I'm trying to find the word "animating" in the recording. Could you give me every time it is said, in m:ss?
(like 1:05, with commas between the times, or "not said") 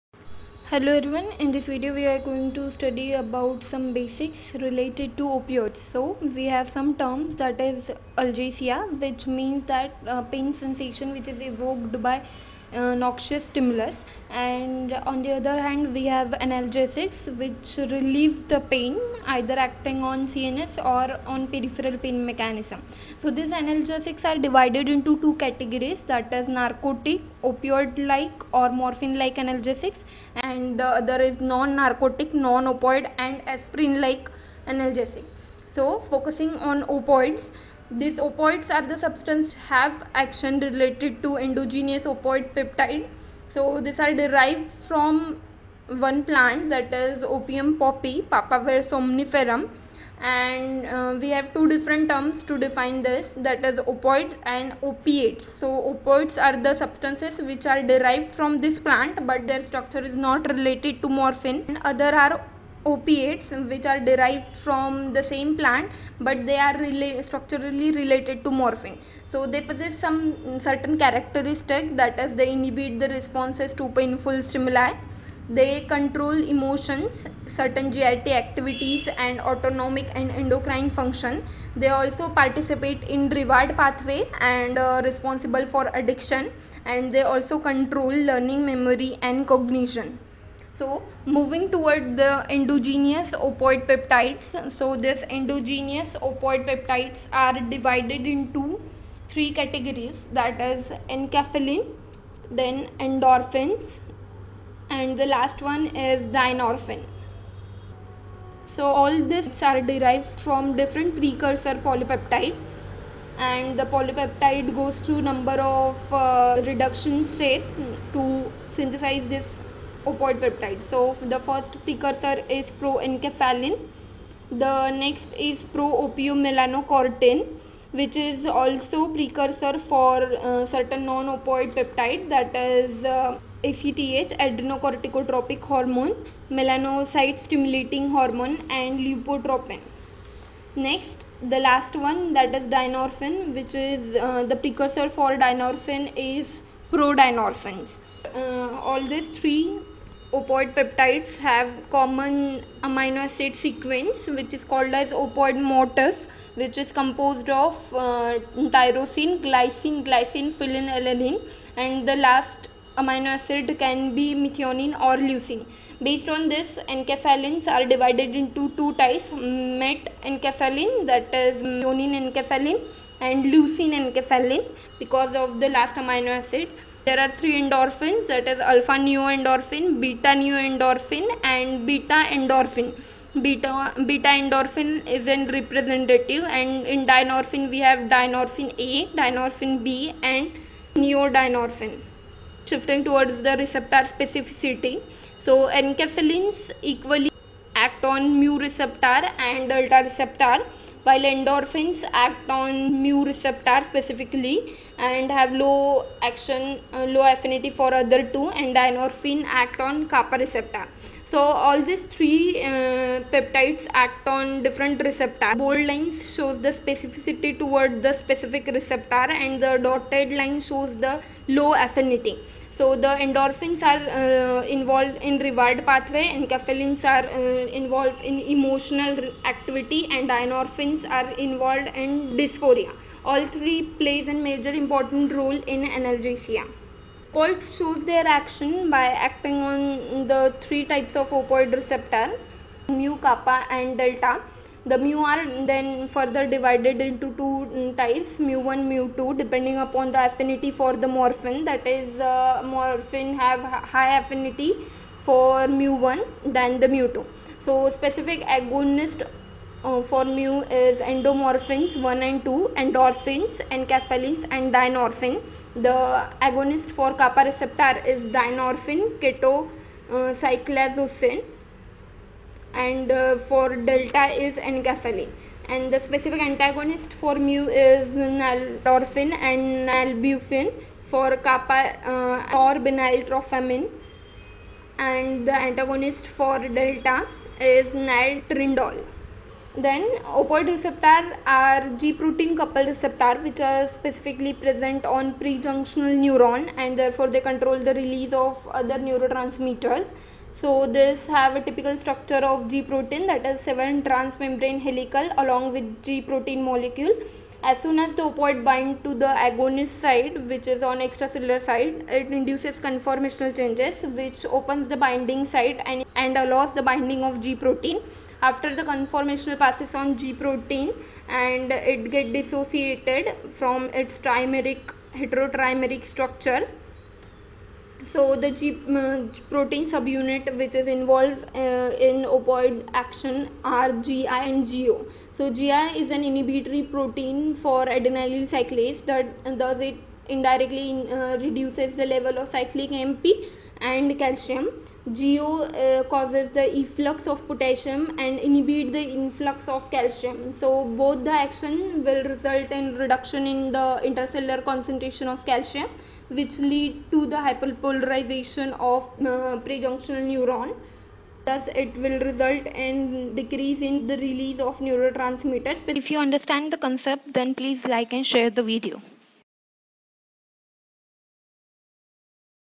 not said.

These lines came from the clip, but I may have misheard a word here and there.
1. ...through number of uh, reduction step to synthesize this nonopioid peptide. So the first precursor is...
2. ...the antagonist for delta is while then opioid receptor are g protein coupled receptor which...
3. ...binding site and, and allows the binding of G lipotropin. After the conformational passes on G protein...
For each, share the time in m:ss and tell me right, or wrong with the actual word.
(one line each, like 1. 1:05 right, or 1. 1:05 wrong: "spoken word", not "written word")
1. 1:55 wrong: "opoid", not "nonopioid"
2. 4:45 wrong: "naltrindole", not "while"
3. 5:14 wrong: "protein", not "lipotropin".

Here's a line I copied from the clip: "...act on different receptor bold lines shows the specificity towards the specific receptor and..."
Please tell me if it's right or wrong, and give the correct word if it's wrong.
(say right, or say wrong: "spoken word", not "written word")
right.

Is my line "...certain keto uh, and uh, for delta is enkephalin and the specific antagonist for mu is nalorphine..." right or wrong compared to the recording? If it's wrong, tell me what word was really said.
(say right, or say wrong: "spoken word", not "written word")
wrong: "dynorphin", not "certain".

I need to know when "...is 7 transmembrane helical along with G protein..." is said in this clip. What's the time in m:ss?
5:03.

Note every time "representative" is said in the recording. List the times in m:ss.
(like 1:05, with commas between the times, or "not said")
3:05.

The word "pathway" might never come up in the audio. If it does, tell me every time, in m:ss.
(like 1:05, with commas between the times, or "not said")
1:23, 3:45.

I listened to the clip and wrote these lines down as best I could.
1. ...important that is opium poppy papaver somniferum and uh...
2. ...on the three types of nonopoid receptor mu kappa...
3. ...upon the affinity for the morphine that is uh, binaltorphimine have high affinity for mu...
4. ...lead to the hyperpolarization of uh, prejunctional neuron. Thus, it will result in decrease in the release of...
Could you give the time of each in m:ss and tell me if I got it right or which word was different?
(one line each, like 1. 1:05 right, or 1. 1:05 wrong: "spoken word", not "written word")
1. 0:46 wrong: "plant", not "important"
2. 3:59 wrong: "opioid", not "nonopoid"
3. 4:09 wrong: "morphine", not "binaltorphimine"
4. 5:56 right.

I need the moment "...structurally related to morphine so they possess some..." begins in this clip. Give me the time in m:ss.
1:07.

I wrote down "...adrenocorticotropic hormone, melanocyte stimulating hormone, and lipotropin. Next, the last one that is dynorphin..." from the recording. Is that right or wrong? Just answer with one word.
right.